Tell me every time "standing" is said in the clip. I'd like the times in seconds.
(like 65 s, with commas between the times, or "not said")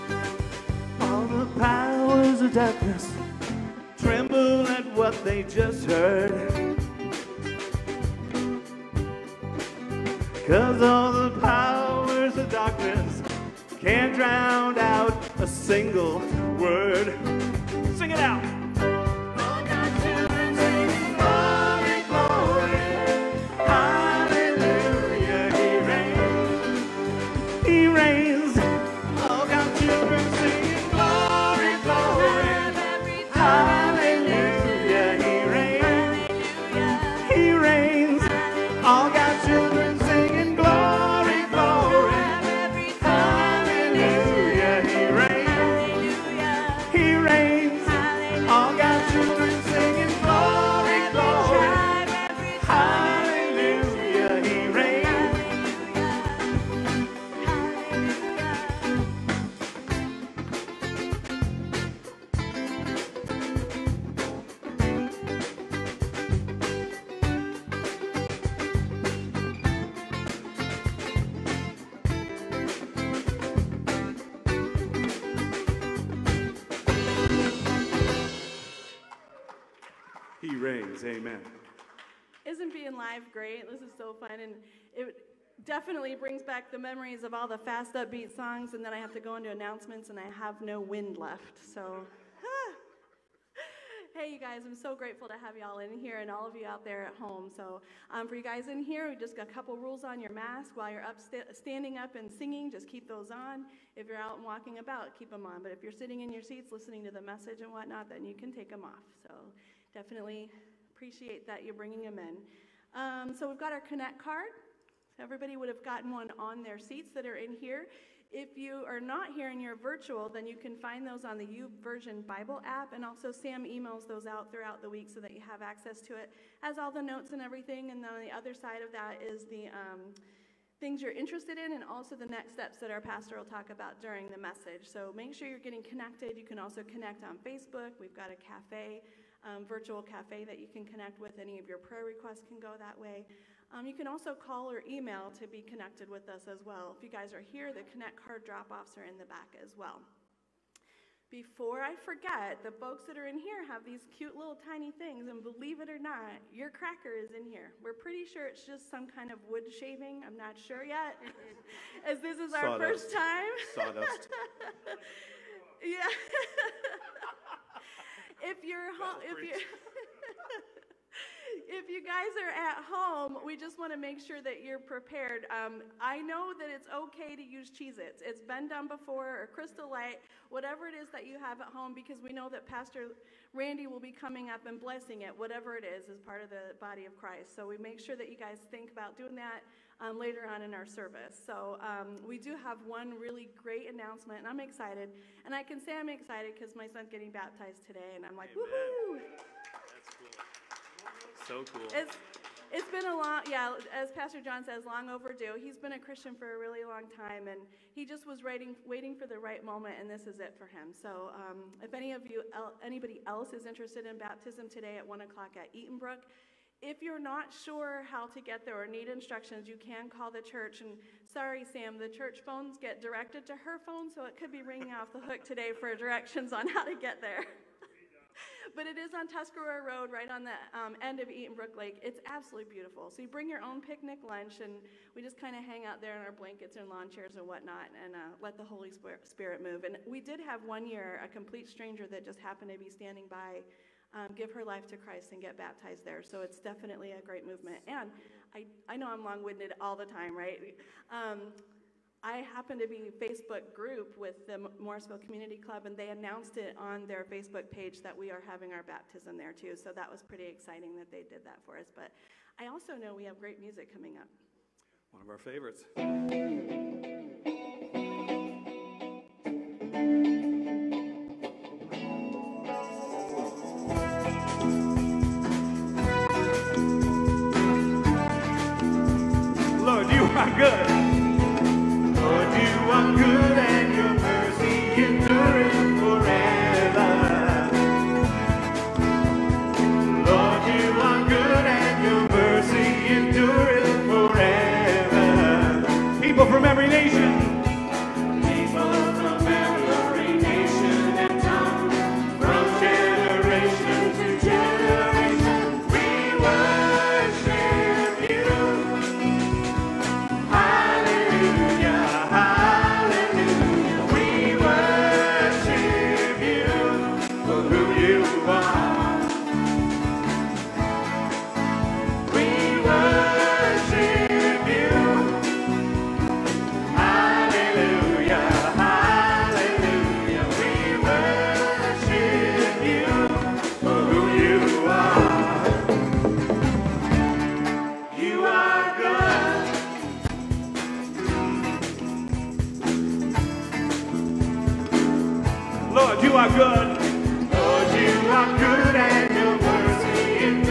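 101 s, 242 s.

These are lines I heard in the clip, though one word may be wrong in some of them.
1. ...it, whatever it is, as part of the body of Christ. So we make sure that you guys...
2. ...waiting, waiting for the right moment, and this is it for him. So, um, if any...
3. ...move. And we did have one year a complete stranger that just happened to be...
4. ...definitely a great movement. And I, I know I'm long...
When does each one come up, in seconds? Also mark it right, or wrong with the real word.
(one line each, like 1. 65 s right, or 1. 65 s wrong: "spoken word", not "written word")
1. 185 s right
2. 208 s right
3. 239 s right
4. 246 s right.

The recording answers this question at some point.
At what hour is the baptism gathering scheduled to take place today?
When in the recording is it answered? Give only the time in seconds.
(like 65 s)
215 s.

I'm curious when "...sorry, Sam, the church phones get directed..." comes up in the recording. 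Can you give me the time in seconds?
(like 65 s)
221 s.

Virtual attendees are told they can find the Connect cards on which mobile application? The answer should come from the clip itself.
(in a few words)
YouVersion Bible app.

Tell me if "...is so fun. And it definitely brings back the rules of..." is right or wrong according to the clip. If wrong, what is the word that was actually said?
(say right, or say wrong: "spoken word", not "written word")
wrong: "memories", not "rules".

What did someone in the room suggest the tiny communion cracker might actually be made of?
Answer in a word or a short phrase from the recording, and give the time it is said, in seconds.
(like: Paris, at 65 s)
Sawdust, at 163 s.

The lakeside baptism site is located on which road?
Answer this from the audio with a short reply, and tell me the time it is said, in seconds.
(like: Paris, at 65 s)
Tuscarora Road, at 229 s.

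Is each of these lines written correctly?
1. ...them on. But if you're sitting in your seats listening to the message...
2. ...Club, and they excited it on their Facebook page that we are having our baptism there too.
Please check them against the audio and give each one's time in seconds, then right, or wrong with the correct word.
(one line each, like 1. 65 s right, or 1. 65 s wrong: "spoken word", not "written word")
1. 105 s right
2. 255 s wrong: "announced", not "excited".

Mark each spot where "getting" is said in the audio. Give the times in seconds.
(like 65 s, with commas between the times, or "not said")
135 s, 197 s.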